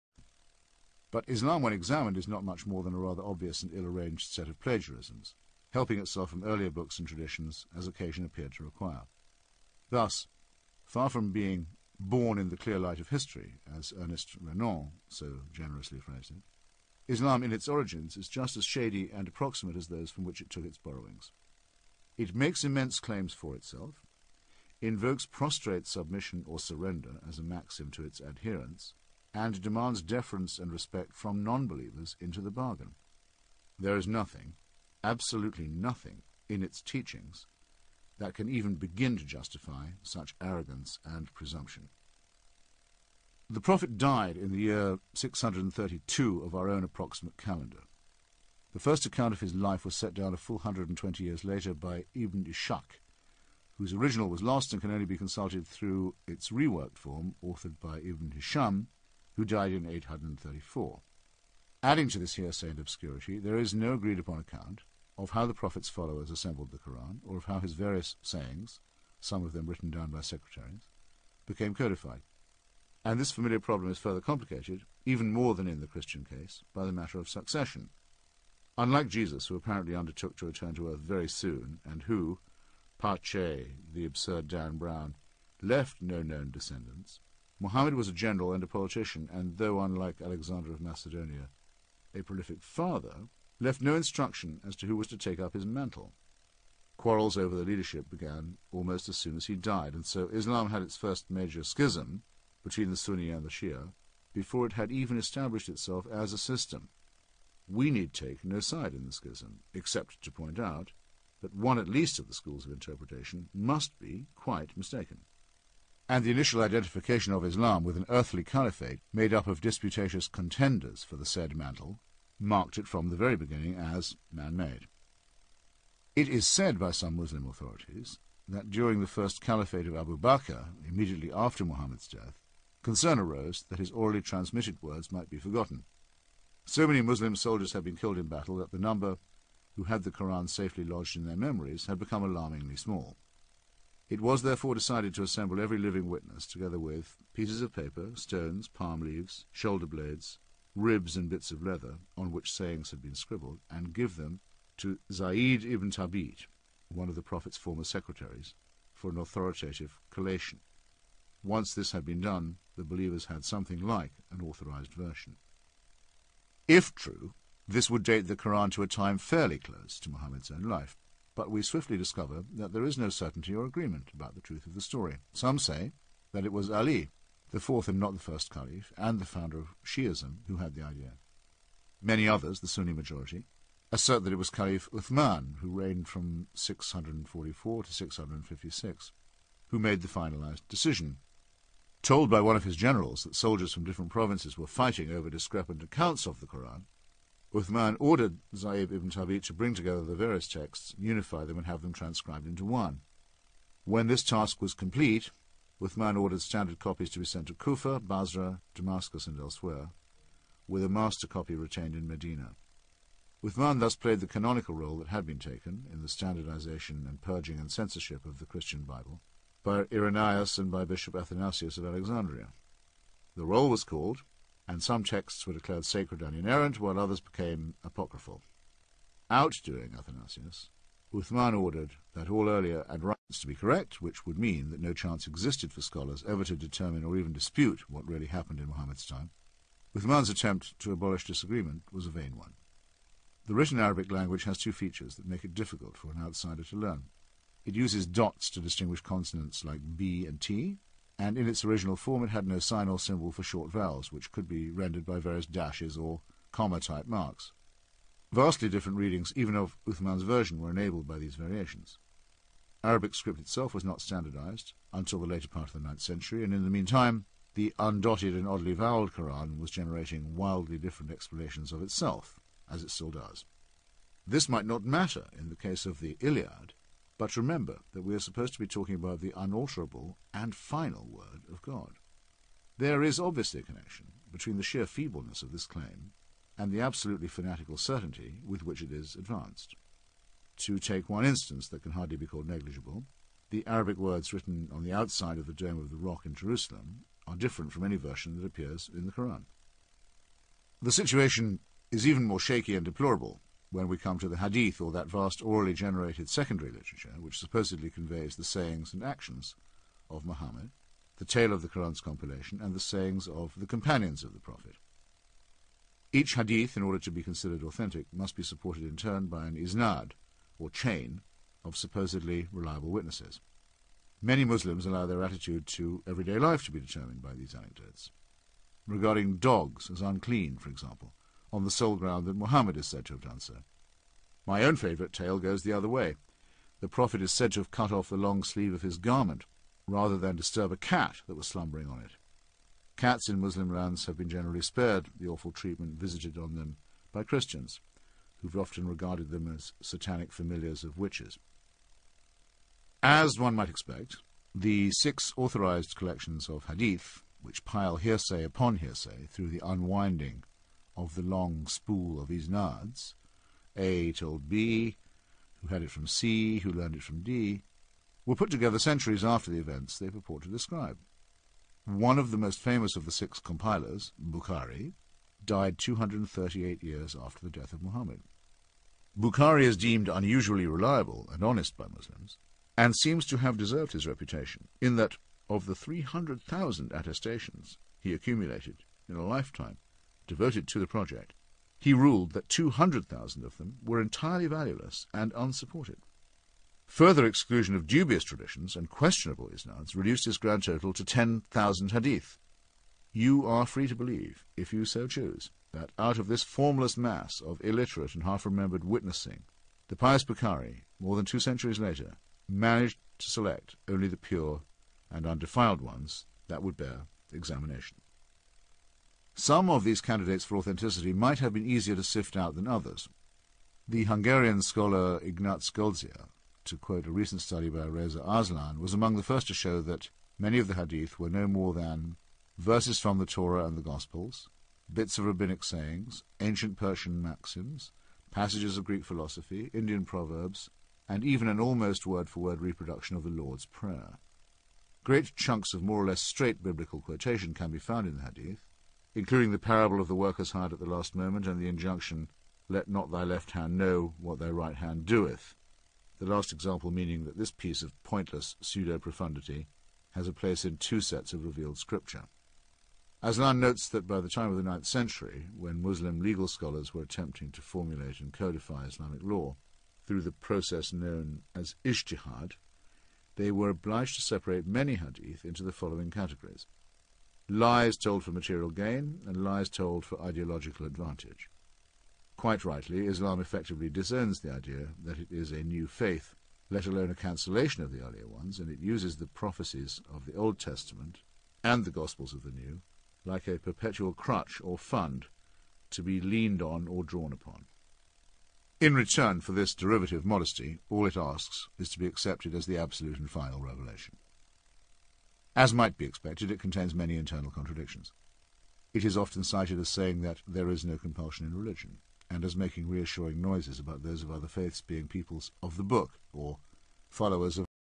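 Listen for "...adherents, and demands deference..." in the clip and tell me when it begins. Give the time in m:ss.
0:28.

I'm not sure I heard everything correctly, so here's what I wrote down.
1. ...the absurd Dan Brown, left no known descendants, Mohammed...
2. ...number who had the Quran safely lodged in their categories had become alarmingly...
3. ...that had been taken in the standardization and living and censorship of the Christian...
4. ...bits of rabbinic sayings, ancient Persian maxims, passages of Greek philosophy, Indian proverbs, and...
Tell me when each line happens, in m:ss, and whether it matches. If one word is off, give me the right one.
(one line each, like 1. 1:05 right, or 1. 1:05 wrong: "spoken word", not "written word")
1. 1:23 right
2. 2:18 wrong: "memories", not "categories"
3. 3:34 wrong: "purging", not "living"
4. 7:14 right.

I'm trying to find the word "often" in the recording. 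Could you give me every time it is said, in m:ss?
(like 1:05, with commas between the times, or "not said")
5:48, 8:29.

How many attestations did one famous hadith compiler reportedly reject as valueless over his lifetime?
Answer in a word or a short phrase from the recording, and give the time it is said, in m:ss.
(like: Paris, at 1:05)
200,000, at 6:32.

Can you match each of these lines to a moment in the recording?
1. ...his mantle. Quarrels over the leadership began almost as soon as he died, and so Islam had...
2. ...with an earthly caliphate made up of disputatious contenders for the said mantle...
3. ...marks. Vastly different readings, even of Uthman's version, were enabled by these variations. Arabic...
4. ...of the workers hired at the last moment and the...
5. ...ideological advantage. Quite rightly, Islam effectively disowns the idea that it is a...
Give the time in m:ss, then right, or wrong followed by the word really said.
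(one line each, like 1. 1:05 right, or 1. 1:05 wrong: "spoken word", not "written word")
1. 1:35 right
2. 1:57 right
3. 4:17 right
4. 7:29 right
5. 8:00 right.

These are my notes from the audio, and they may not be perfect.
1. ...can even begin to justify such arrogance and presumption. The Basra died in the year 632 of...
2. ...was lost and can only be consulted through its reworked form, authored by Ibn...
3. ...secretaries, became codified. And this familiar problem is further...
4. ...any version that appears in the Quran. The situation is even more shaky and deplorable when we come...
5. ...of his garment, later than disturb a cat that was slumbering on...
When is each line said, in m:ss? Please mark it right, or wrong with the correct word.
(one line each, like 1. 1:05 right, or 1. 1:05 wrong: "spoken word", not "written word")
1. 0:38 wrong: "Prophet", not "Basra"
2. 0:54 right
3. 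1:10 right
4. 4:57 right
5. 5:38 wrong: "rather", not "later".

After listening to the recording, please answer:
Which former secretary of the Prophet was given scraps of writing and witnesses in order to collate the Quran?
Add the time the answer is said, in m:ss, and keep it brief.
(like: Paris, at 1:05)
Zaid ibn Thabit, at 2:35.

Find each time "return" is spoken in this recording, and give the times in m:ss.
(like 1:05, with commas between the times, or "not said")
1:20, 8:18.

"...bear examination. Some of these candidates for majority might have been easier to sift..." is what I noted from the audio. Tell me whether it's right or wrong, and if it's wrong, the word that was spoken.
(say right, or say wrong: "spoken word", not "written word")
wrong: "authenticity", not "majority".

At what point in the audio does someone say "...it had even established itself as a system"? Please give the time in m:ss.
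1:44.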